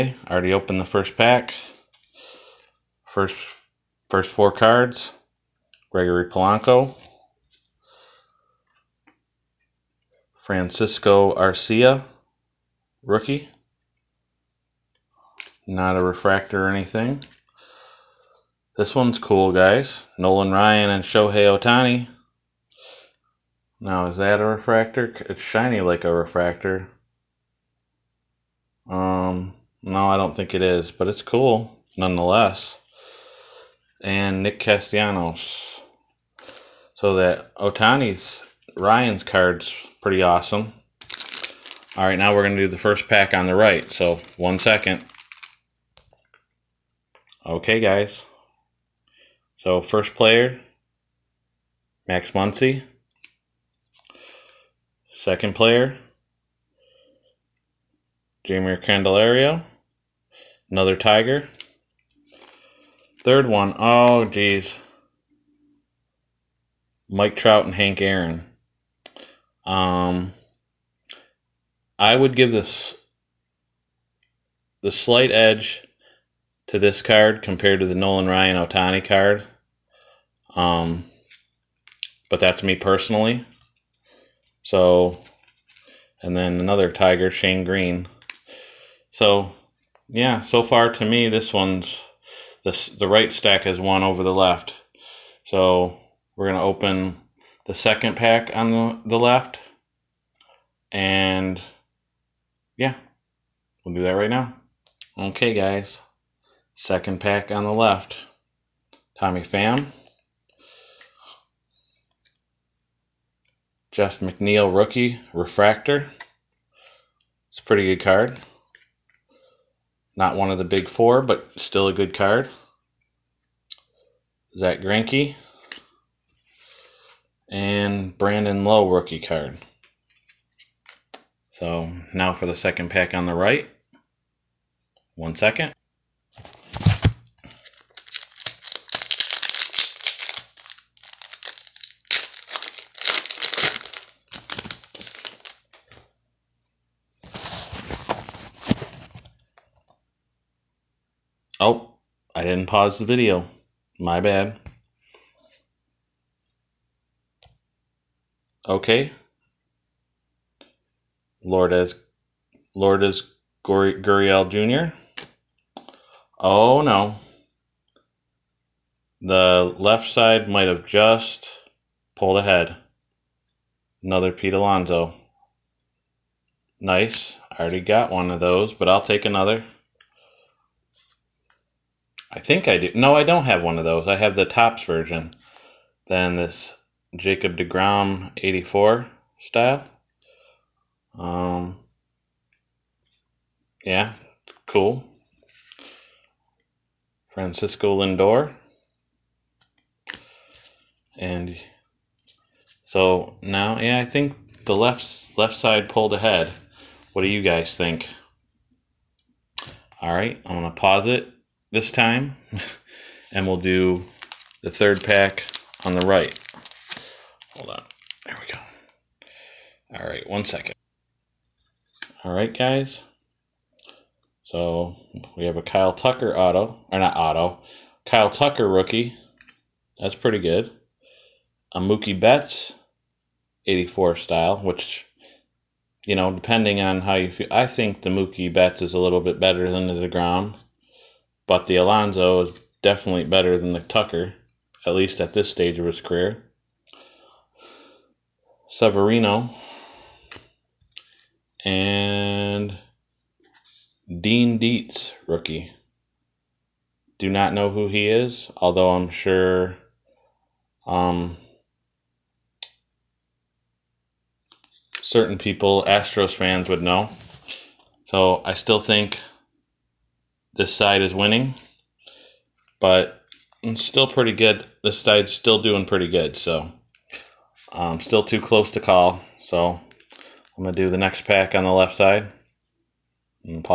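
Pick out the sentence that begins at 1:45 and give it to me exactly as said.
Okay, guys, second pack on the left.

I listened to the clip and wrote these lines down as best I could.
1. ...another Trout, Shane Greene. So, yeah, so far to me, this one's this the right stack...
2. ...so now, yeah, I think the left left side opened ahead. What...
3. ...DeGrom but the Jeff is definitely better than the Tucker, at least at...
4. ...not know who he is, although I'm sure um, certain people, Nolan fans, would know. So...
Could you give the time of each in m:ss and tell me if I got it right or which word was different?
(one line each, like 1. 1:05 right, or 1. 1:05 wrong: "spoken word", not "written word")
1. 1:26 wrong: "Tiger", not "Trout"
2. 3:22 wrong: "pulled", not "opened"
3. 3:59 wrong: "Alonso", not "Jeff"
4. 4:17 wrong: "Astros", not "Nolan".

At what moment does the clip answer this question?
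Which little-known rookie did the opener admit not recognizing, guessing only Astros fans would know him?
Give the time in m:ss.
4:14.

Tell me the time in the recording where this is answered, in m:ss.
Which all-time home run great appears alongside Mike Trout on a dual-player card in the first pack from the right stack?
1:07.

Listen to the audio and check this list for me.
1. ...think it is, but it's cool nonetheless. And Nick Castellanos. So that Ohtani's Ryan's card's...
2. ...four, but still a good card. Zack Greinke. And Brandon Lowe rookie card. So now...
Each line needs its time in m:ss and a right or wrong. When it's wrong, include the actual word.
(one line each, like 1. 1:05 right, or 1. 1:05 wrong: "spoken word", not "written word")
1. 0:30 right
2. 2:00 right.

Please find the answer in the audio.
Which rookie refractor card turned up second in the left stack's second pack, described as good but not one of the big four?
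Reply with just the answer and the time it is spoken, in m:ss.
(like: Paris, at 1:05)
Jeff McNeil, at 1:53.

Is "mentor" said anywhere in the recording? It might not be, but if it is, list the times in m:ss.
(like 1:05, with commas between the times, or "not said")
not said.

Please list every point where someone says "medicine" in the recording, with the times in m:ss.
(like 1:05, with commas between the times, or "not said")
not said.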